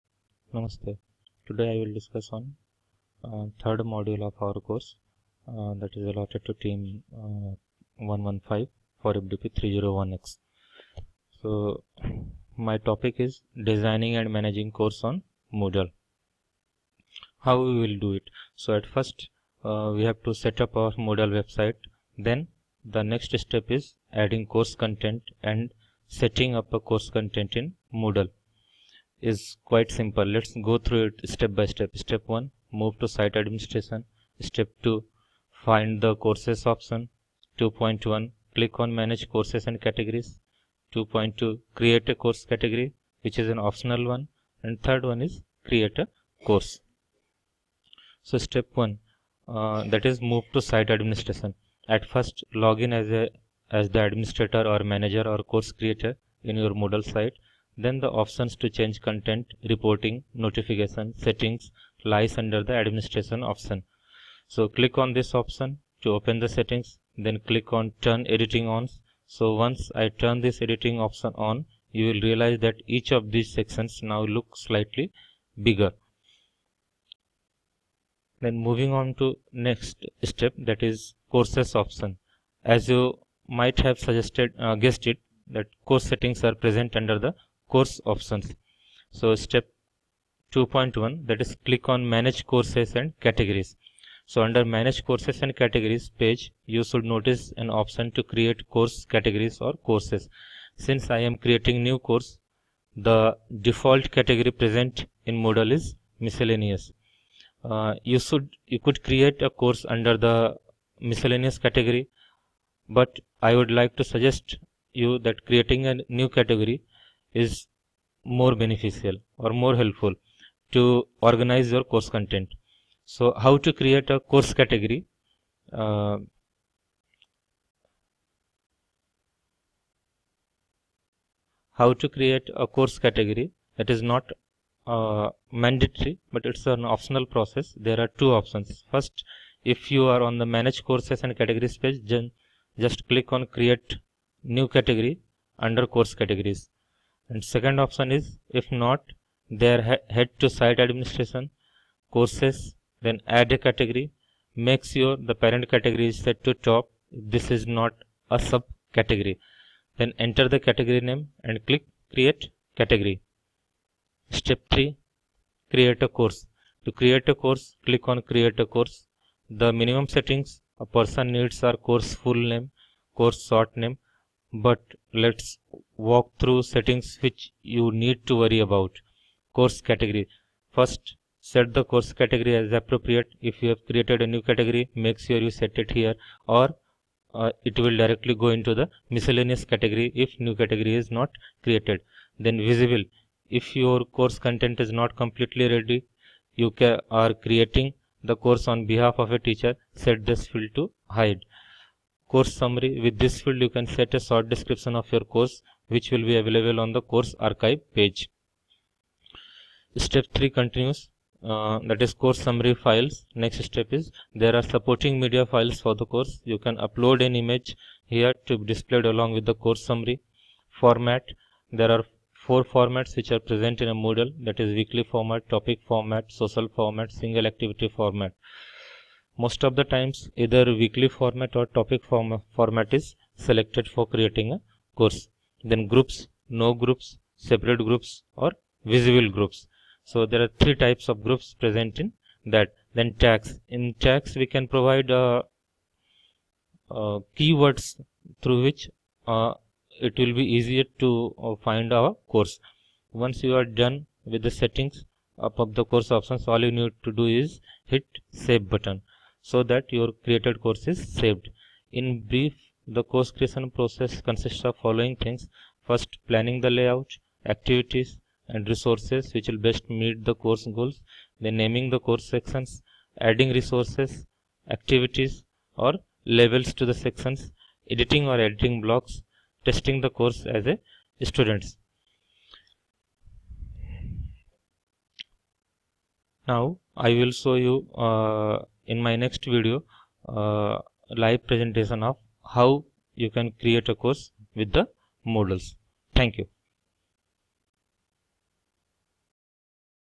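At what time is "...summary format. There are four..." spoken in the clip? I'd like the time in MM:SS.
03:39.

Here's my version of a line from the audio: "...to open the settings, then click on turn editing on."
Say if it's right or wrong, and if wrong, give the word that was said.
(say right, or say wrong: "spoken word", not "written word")
right.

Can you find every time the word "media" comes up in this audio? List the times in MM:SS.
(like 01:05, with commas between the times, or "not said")
03:35.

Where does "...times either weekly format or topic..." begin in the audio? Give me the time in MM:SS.
03:49.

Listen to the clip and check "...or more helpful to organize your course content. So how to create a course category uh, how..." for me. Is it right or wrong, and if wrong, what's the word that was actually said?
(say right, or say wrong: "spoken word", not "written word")
right.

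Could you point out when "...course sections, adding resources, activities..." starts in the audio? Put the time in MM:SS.
04:32.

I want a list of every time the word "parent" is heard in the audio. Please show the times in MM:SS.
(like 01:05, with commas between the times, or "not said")
02:35.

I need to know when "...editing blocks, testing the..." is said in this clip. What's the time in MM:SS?
04:38.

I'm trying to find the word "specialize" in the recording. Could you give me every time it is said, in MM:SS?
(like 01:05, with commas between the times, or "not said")
not said.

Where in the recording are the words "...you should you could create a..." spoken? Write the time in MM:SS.
01:48.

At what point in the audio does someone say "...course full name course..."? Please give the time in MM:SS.
02:51.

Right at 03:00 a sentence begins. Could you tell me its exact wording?
First, set the course category as appropriate.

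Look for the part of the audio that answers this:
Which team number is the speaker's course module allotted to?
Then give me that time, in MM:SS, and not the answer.
00:07.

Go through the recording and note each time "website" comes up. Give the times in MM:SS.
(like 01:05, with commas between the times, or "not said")
00:21.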